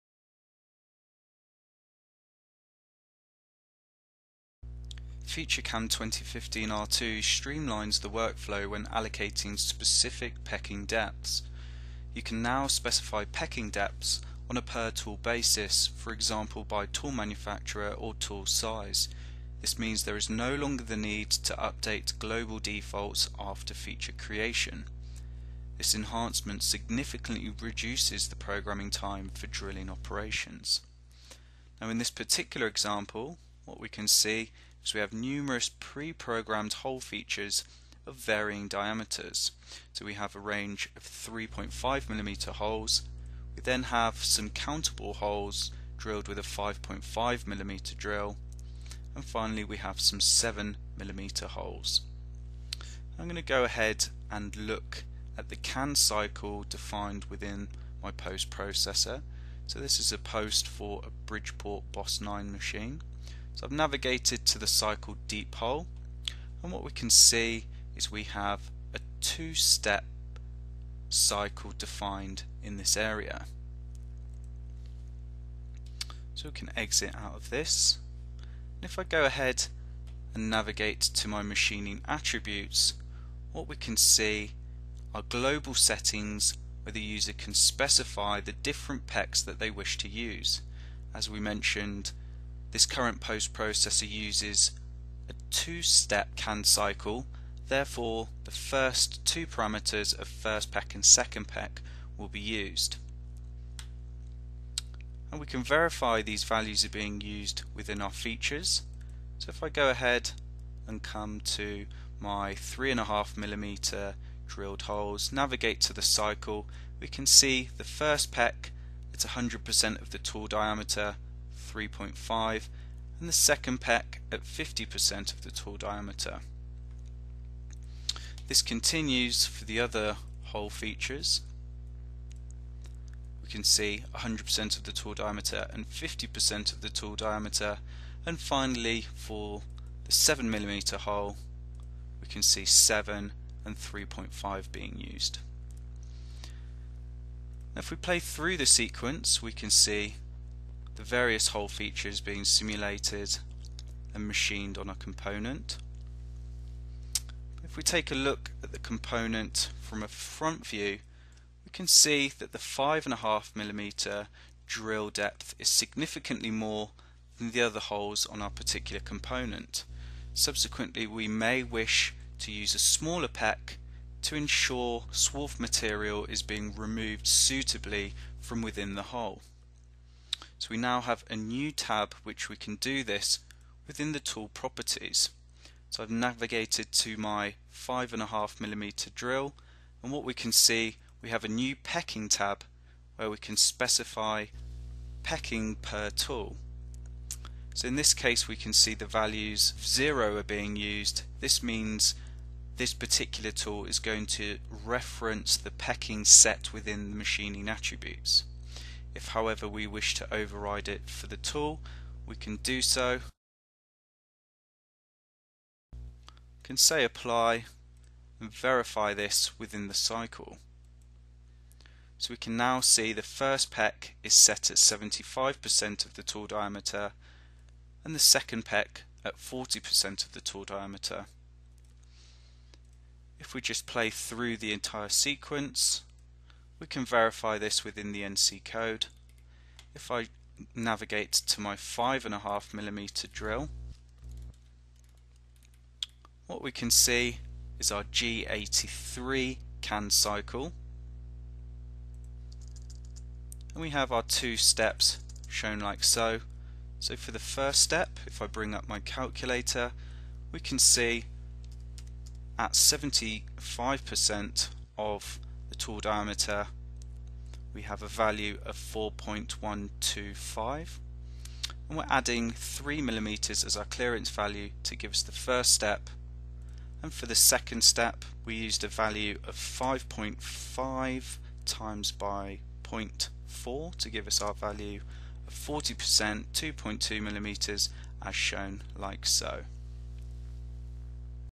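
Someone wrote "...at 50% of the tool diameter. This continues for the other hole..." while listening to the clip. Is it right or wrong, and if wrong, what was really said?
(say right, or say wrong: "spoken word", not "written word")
right.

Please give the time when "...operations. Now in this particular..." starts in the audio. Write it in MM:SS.
00:29.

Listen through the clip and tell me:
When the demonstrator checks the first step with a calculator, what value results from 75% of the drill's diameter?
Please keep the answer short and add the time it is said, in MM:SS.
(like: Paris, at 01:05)
4.125, at 04:28.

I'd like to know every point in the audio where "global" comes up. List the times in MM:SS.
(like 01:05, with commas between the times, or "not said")
00:22, 01:25.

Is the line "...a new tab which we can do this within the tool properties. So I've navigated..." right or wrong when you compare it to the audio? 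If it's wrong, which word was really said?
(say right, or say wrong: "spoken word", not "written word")
right.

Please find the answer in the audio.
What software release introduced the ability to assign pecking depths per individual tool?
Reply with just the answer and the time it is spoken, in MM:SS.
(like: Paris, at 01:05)
FeatureCAM 2015 R2, at 00:05.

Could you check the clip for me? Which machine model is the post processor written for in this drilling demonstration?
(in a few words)
Bridgeport Boss 9.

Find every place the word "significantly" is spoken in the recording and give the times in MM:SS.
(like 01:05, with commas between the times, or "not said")
00:26, 02:45.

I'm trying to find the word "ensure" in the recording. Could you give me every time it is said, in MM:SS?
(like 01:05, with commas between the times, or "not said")
02:54.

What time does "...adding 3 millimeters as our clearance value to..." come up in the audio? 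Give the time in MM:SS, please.
04:32.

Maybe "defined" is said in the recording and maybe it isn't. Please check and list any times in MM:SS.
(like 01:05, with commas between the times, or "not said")
00:56, 01:11.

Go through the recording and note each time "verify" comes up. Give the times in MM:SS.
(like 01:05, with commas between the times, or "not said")
01:45, 03:38, 03:57.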